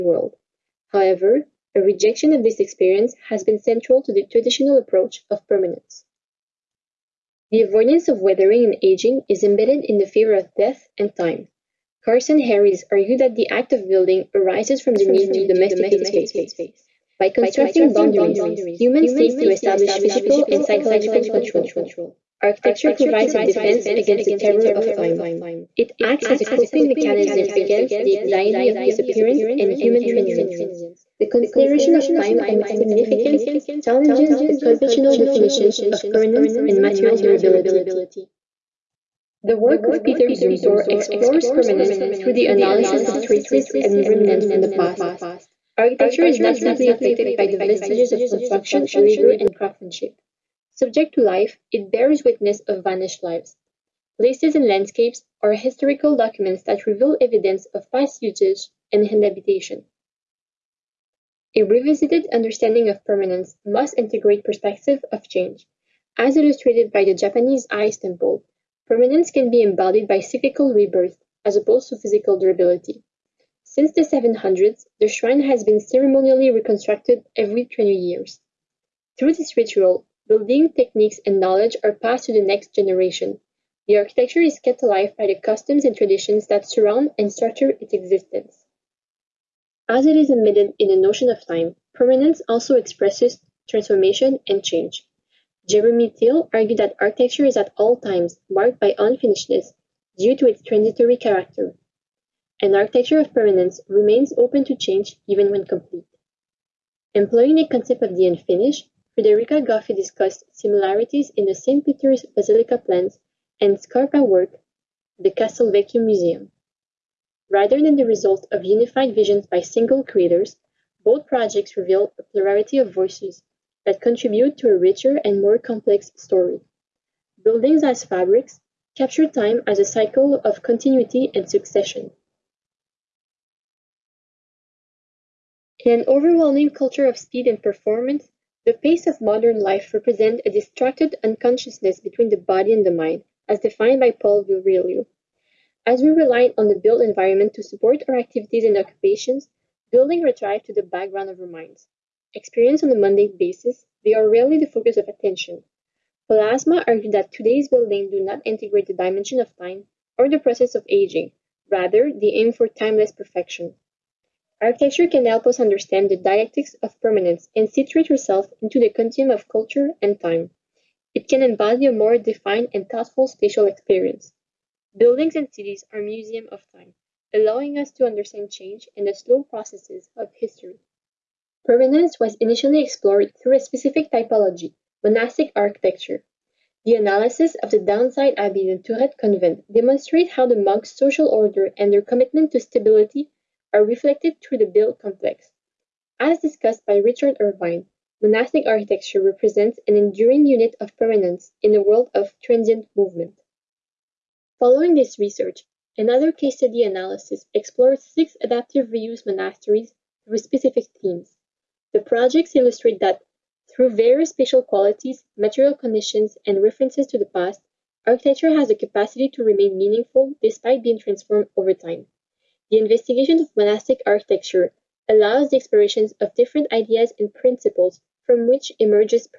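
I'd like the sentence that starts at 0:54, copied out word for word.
Places and landscapes are historical documents that reveal evidence of past usage and habitation.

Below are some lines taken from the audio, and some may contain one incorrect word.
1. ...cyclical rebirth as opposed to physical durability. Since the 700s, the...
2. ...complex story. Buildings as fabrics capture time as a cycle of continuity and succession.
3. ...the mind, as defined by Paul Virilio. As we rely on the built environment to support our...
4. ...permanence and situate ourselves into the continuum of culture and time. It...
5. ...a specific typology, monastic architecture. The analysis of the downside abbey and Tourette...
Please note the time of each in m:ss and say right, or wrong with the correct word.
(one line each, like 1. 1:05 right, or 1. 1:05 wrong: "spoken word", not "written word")
1. 1:10 right
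2. 2:05 right
3. 2:22 right
4. 2:46 right
5. 3:03 right.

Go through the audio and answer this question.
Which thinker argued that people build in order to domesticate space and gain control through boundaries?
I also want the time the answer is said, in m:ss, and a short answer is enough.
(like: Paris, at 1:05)
Karsten Harries, at 0:12.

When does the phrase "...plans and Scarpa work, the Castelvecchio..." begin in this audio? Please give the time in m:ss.
1:52.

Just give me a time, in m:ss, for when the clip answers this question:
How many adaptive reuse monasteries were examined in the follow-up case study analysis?
3:28.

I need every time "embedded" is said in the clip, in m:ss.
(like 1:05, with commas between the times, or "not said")
0:09, 1:30.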